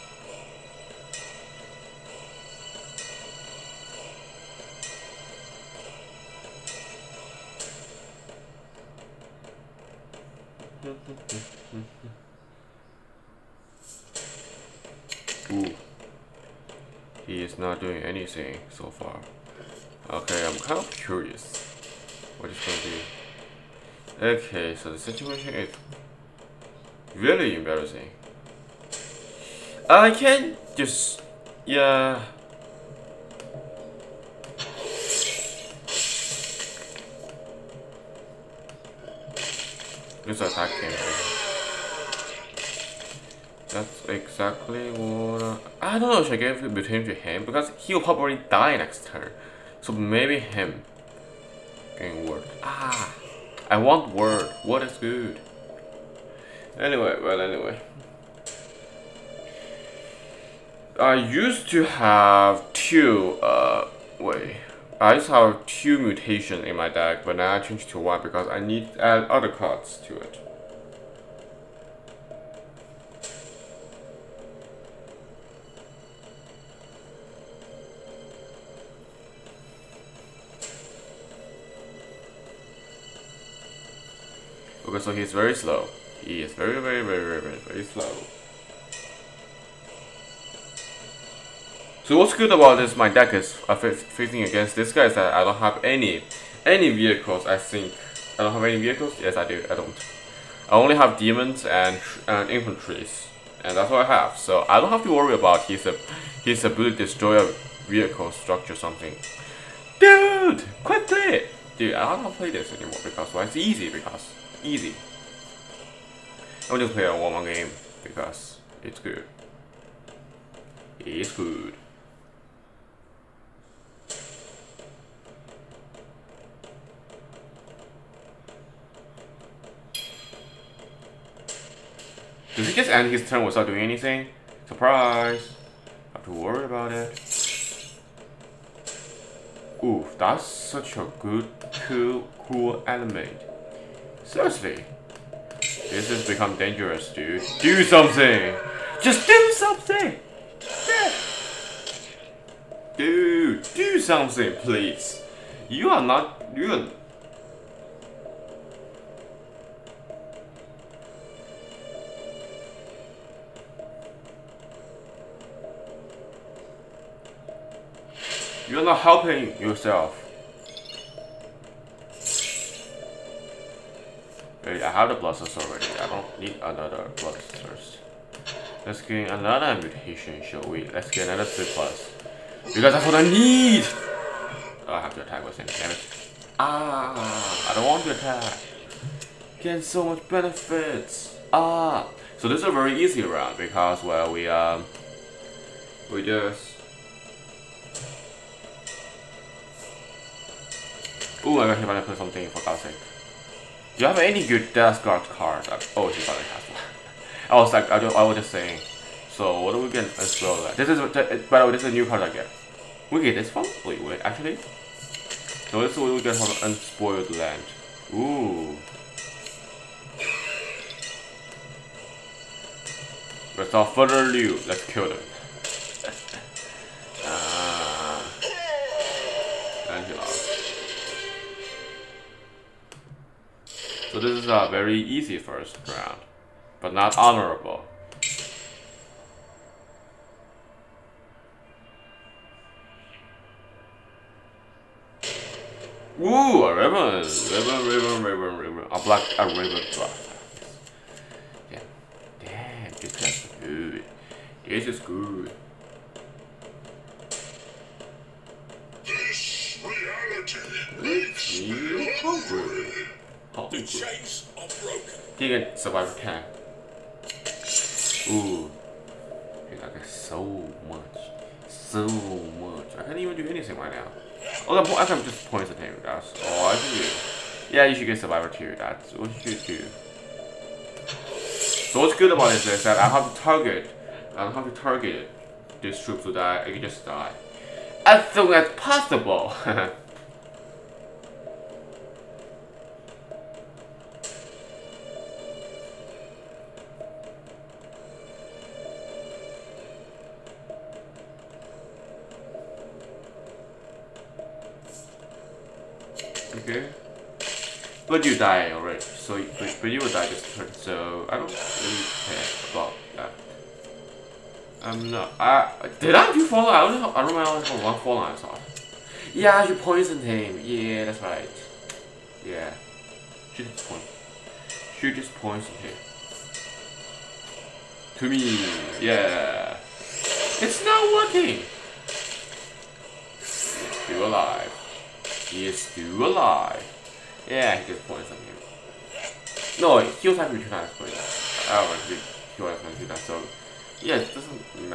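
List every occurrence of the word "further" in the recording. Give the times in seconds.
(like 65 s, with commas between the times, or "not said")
223 s.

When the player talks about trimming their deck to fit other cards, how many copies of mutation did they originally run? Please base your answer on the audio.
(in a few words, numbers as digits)
2.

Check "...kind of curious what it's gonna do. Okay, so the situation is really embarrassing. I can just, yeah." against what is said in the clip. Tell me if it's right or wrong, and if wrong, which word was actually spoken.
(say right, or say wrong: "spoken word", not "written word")
right.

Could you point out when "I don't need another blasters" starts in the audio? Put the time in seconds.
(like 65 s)
175 s.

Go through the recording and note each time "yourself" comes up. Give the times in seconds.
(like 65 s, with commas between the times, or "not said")
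169 s.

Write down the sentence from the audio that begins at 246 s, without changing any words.
Ooh, a ribbon, ribbon, ribbon, ribbon, ribbon.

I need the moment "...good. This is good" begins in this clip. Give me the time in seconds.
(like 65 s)
253 s.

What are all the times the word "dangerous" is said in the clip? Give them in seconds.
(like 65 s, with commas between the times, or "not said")
146 s.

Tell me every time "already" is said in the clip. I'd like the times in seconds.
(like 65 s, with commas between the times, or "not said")
175 s, 308 s.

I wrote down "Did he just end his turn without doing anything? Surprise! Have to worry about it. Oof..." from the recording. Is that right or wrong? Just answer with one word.
right.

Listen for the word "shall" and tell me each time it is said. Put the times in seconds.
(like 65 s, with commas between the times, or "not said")
180 s.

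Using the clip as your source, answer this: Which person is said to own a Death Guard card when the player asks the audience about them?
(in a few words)
Hibana.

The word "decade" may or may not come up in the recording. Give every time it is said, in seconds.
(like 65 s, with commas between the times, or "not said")
not said.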